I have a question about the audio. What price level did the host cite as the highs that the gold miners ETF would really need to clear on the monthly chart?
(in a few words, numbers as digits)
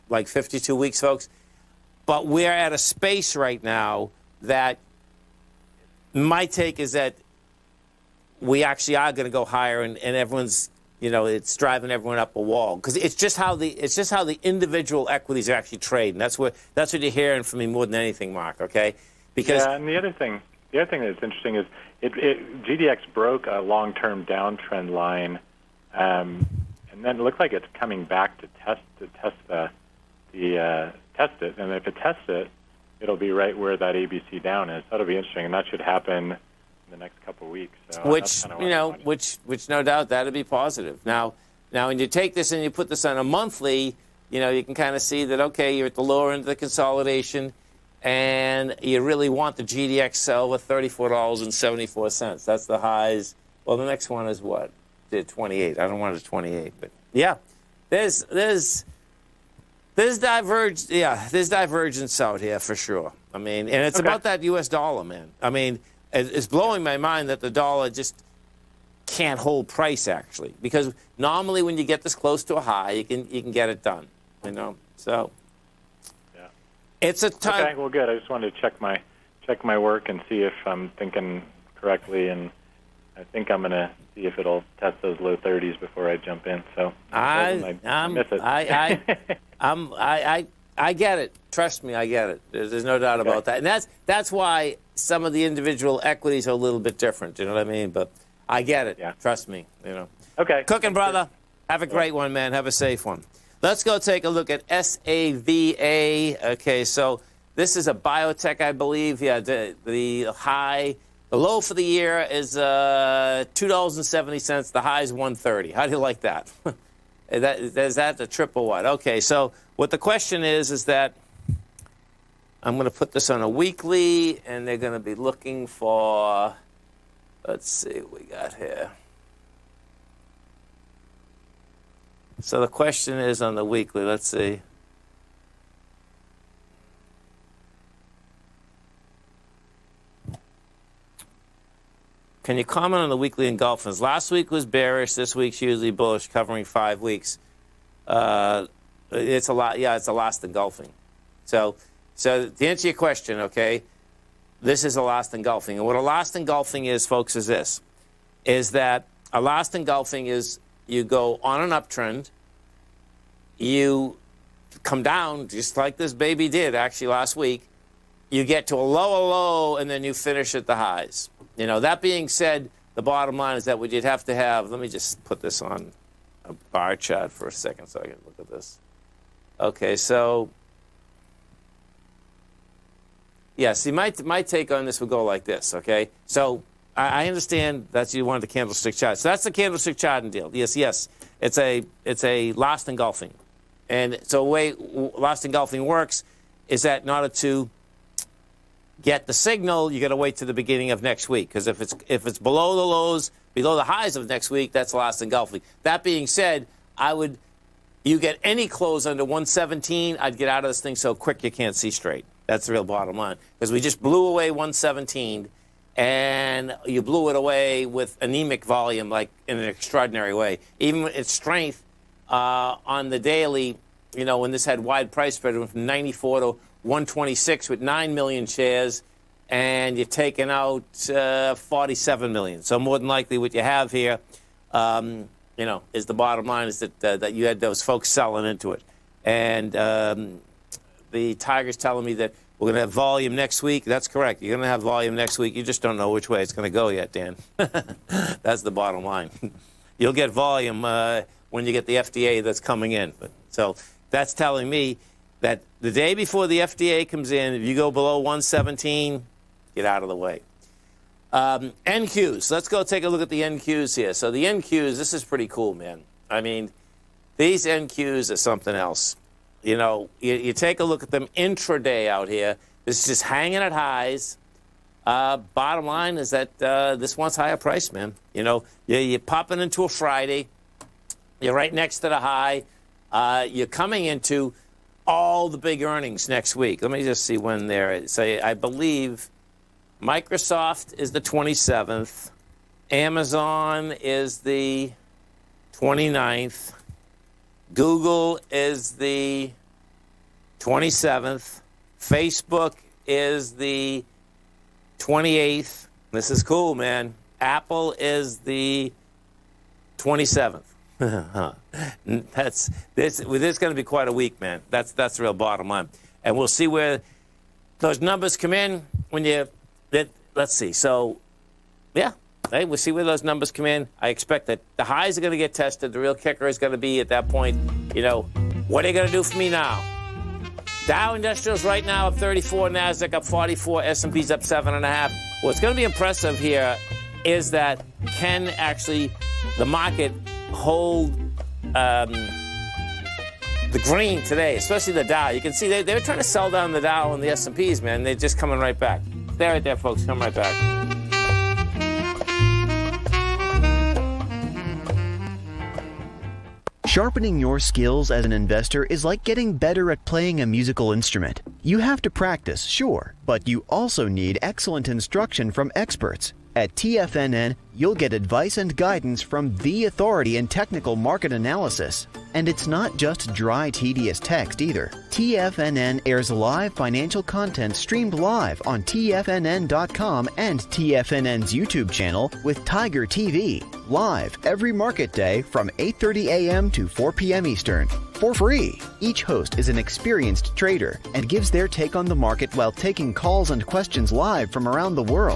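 $34.74.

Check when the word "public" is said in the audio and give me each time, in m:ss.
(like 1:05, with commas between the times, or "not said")
not said.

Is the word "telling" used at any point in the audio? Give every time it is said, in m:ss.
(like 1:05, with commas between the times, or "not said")
4:01, 4:14.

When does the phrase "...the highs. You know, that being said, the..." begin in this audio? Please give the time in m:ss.
2:50.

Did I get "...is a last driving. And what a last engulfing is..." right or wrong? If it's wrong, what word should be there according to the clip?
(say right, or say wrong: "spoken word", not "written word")
wrong: "engulfing", not "driving".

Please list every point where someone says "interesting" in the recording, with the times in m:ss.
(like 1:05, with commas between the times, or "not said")
0:21, 0:35.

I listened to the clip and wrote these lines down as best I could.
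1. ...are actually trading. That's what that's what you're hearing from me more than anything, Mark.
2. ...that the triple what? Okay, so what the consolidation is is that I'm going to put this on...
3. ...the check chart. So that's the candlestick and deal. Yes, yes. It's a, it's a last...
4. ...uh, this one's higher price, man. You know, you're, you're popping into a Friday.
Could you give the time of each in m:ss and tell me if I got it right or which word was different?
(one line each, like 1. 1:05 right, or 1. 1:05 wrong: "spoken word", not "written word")
1. 0:15 right
2. 1:57 wrong: "question", not "consolidation"
3. 3:08 wrong: "candlestick", not "check"
4. 4:36 right.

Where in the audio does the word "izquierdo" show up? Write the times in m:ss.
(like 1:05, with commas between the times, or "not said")
not said.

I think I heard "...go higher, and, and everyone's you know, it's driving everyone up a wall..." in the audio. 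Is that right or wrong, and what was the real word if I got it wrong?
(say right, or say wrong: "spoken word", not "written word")
right.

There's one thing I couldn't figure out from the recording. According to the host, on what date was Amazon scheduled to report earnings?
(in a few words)
29th.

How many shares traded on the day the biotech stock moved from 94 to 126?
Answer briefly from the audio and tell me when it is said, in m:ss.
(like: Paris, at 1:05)
9 million, at 3:47.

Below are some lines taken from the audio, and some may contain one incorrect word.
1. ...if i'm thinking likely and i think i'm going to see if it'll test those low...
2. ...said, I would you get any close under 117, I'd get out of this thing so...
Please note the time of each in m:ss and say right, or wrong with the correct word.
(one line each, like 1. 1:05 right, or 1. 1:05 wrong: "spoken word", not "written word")
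1. 1:20 wrong: "correctly", not "likely"
2. 3:26 right.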